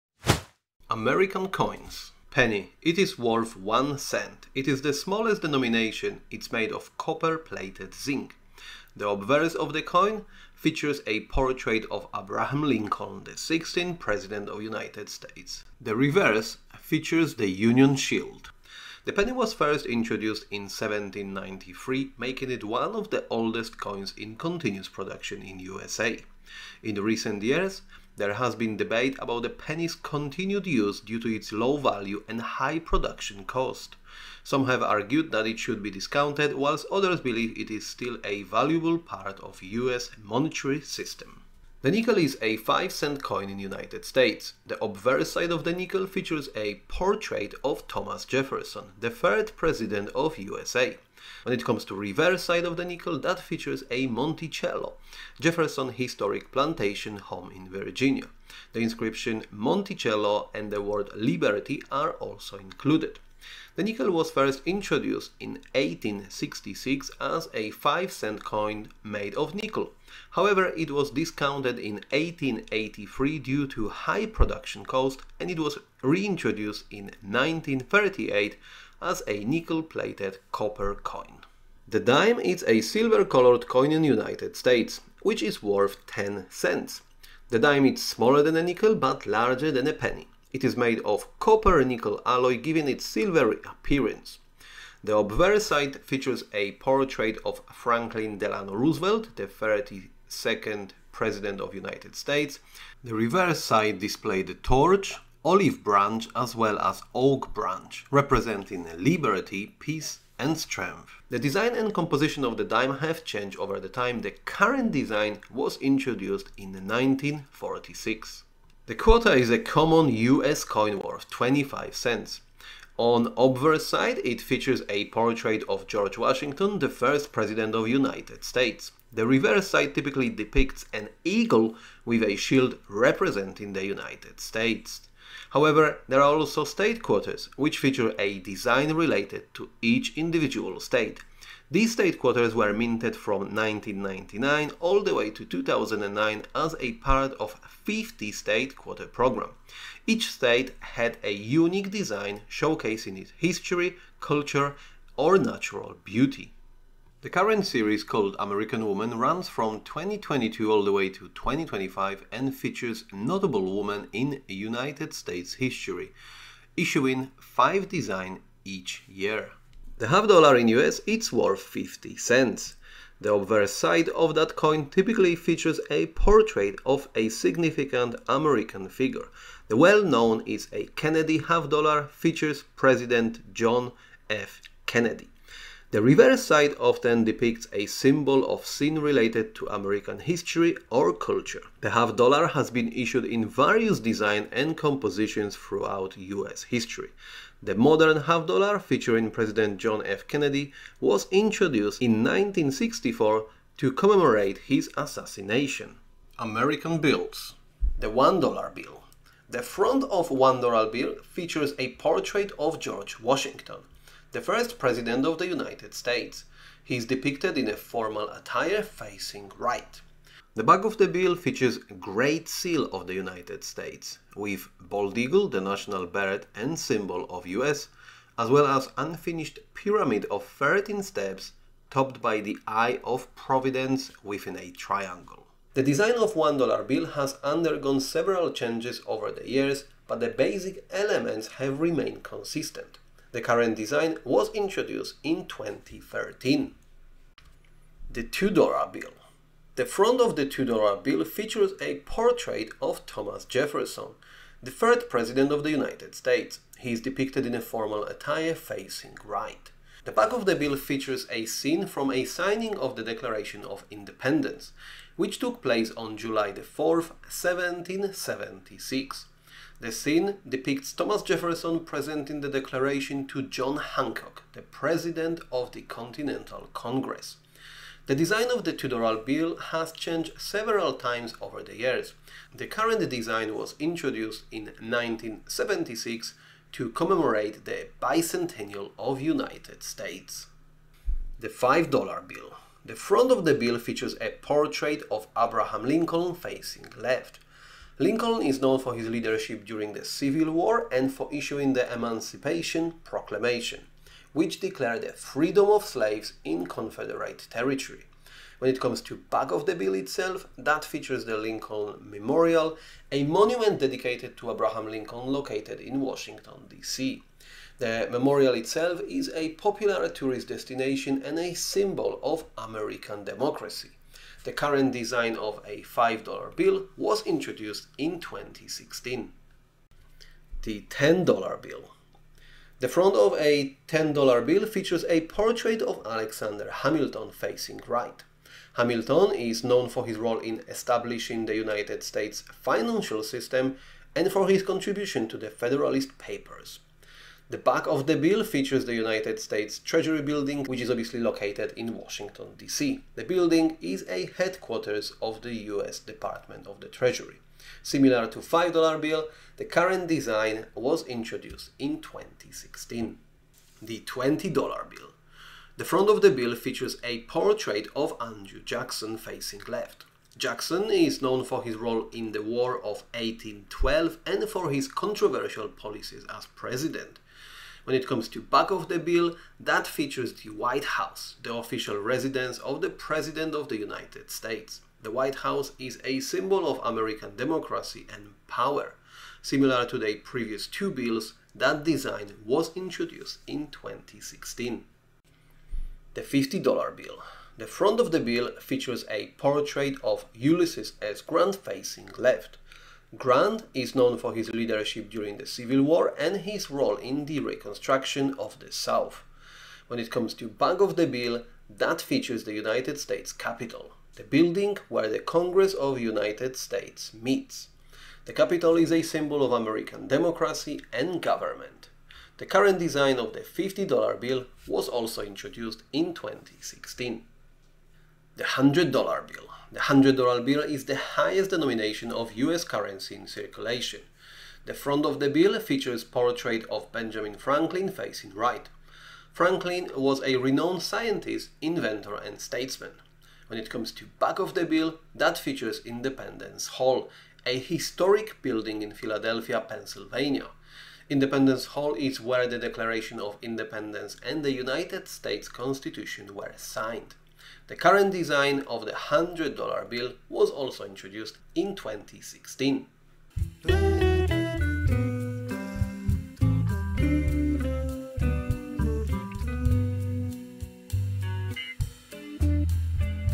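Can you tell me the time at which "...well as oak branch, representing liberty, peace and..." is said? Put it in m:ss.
1:46.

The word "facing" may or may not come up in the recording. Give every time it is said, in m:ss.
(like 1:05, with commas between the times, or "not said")
3:38, 4:18, 4:56, 5:37, 6:09, 6:41, 7:17.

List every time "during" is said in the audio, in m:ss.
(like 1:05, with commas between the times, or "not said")
4:59, 6:45.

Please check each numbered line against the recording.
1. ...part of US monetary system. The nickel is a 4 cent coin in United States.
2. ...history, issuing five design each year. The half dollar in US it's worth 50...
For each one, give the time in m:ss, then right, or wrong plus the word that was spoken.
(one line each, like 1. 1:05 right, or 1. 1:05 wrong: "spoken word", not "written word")
1. 0:38 wrong: "5", not "4"
2. 2:45 right.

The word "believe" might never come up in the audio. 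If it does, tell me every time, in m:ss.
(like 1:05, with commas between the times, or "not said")
0:37.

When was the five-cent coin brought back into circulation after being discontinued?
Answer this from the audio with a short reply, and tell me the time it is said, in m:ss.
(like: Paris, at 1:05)
1938, at 1:17.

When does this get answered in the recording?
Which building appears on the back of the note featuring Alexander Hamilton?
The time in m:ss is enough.
5:48.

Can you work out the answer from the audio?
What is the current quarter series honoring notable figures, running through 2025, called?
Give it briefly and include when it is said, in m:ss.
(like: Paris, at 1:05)
American Woman, at 2:38.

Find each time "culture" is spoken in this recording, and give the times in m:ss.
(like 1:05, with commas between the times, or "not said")
2:34, 3:11.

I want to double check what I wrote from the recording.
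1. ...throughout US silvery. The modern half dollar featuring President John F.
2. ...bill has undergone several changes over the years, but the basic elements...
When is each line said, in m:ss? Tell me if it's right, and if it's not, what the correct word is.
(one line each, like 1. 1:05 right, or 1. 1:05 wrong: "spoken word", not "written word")
1. 3:15 wrong: "history", not "silvery"
2. 3:56 right.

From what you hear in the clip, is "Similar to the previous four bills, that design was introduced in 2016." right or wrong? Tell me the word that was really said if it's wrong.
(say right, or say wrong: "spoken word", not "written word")
wrong: "two", not "four".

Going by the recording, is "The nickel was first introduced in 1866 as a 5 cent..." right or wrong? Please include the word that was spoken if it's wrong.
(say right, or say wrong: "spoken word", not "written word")
right.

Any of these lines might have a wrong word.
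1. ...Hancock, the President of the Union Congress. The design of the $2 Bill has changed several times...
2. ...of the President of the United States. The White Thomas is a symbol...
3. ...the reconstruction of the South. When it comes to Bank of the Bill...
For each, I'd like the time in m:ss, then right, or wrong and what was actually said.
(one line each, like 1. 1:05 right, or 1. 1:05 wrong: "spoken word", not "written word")
1. 4:33 wrong: "Continental", not "Union"
2. 6:22 wrong: "House", not "Thomas"
3. 6:47 right.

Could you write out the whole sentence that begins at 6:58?
The Capitol is a symbol of American democracy and government.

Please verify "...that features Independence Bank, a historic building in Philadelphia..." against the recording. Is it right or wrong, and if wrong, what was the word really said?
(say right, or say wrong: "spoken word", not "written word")
wrong: "Hall", not "Bank".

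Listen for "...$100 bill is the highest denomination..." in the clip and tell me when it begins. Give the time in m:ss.
7:09.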